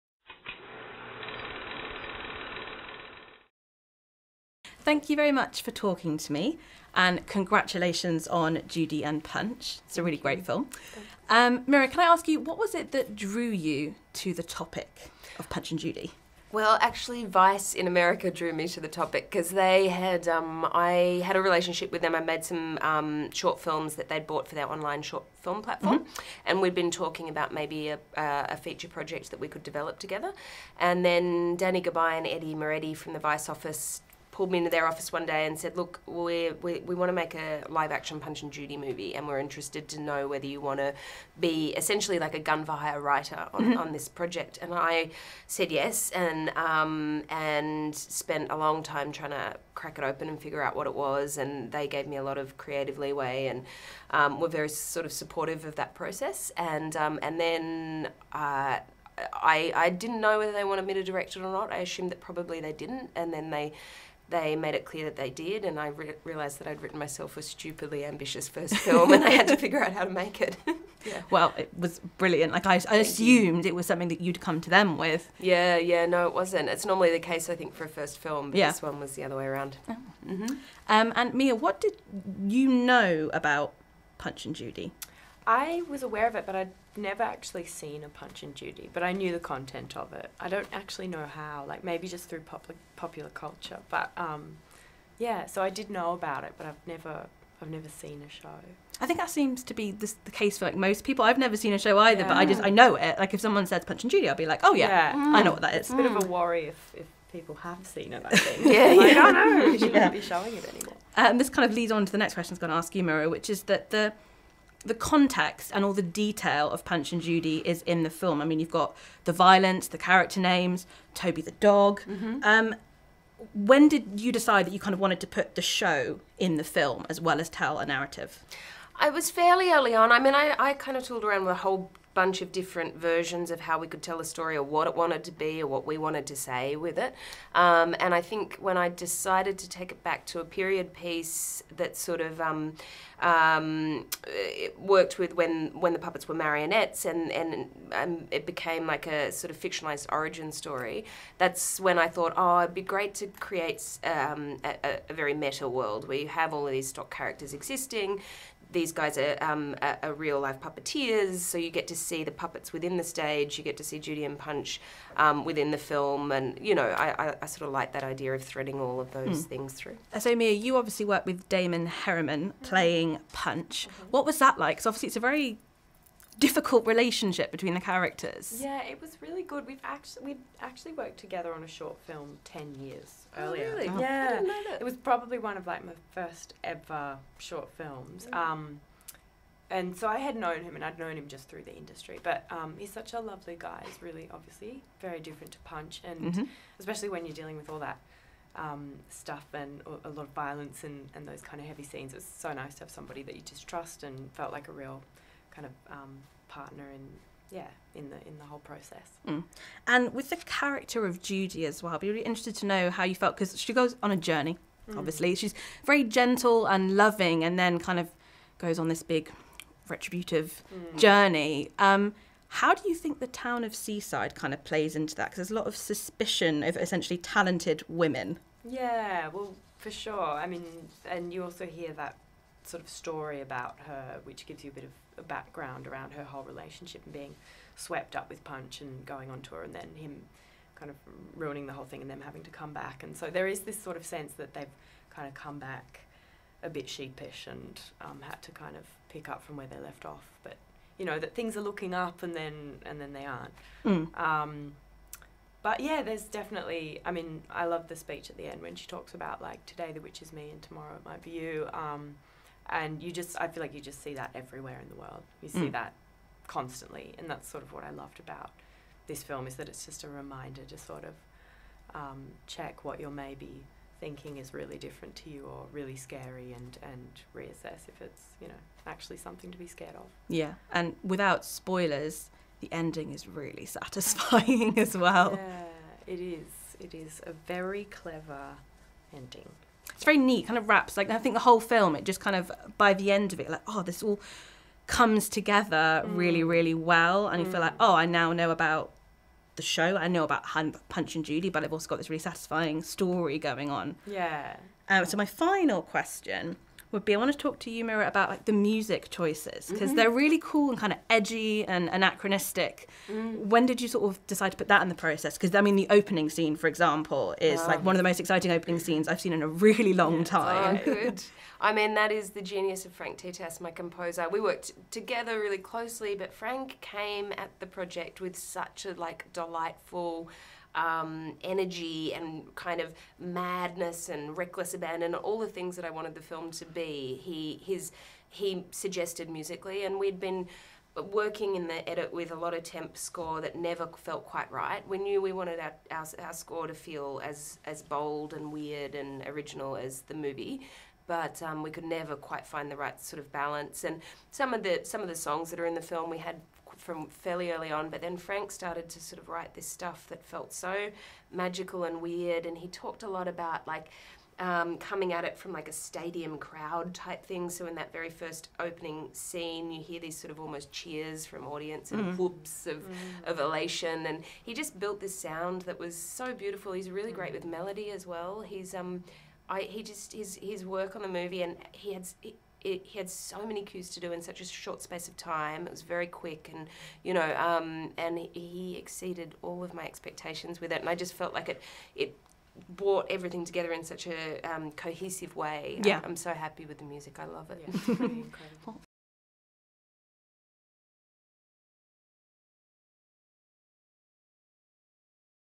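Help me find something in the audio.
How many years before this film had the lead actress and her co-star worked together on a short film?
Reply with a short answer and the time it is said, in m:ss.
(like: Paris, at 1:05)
10, at 3:02.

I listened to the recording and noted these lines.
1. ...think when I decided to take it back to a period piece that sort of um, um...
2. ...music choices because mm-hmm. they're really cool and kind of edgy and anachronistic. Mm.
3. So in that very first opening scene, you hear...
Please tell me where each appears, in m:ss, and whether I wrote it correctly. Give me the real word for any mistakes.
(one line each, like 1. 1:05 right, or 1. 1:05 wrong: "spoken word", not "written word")
1. 2:18 right
2. 5:08 right
3. 6:07 right.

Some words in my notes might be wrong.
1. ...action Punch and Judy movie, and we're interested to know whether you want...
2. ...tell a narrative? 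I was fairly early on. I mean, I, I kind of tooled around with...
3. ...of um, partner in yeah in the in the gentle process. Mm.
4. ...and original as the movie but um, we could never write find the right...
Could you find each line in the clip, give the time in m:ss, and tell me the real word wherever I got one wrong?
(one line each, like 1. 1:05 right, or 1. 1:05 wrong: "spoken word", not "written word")
1. 0:37 right
2. 2:07 right
3. 3:25 wrong: "whole", not "gentle"
4. 5:48 wrong: "quite", not "write".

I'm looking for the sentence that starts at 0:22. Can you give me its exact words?
I made some um, short films that they'd bought for their online short film platform.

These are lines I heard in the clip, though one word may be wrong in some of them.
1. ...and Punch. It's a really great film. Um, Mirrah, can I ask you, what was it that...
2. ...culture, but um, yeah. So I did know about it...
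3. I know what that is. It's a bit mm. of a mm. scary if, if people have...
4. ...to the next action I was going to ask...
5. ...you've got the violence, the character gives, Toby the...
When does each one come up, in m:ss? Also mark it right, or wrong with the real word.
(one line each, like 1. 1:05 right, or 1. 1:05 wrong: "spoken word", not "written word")
1. 0:09 right
2. 1:33 right
3. 1:45 wrong: "worry", not "scary"
4. 1:52 wrong: "question", not "action"
5. 1:58 wrong: "names", not "gives".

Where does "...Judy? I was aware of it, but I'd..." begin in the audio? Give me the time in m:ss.
1:24.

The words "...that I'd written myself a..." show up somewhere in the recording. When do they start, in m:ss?
1:06.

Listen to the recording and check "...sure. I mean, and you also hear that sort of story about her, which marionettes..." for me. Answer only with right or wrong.
wrong.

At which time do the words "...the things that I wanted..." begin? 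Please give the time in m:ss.
5:35.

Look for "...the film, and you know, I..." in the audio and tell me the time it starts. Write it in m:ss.
2:45.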